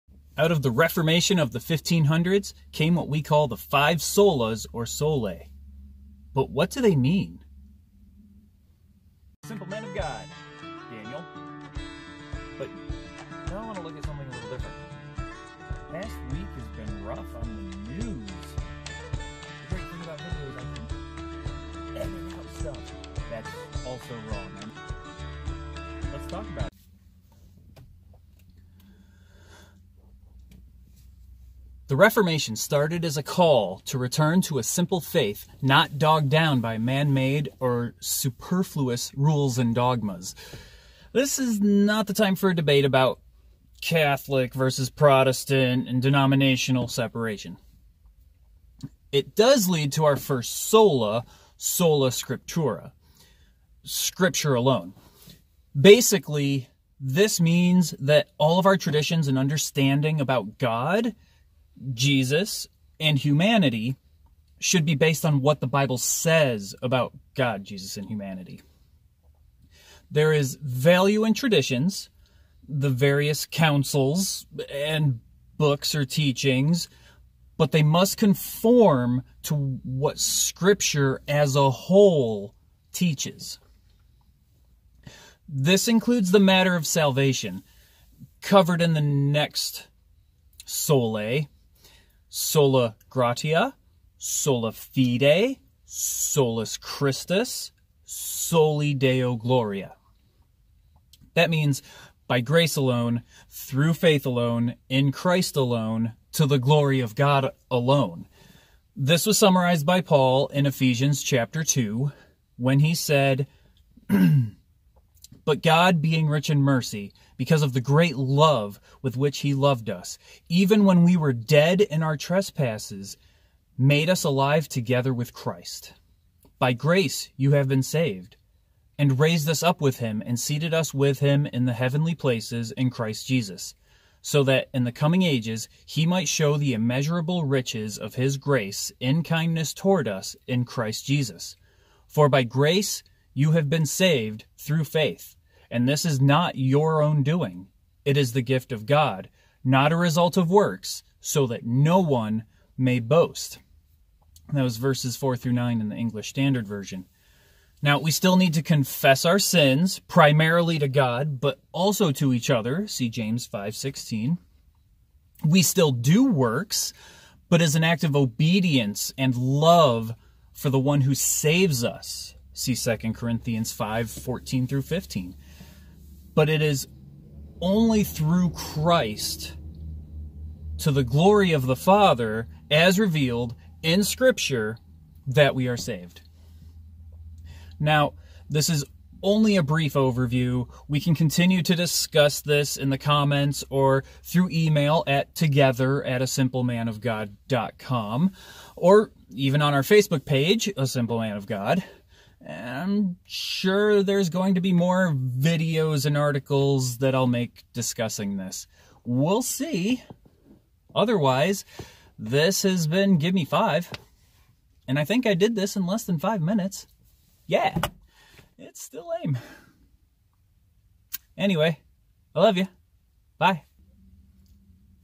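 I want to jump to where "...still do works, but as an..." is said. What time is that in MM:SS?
02:45.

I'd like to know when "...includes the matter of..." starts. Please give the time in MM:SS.
01:25.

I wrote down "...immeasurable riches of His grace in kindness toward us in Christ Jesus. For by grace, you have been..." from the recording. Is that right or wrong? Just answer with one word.
right.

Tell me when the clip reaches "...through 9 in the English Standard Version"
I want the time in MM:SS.
02:35.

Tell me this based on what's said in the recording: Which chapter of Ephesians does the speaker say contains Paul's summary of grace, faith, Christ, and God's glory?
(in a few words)
Chapter 2.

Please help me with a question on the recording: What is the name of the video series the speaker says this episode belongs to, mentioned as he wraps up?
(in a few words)
Give Me Five.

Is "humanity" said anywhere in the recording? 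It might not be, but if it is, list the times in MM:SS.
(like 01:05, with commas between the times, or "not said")
01:03, 01:08.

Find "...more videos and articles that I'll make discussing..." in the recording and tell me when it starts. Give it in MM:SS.
03:24.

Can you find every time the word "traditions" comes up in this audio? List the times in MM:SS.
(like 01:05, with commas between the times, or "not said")
00:58, 01:11.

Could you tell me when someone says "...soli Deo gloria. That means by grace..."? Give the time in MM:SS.
01:38.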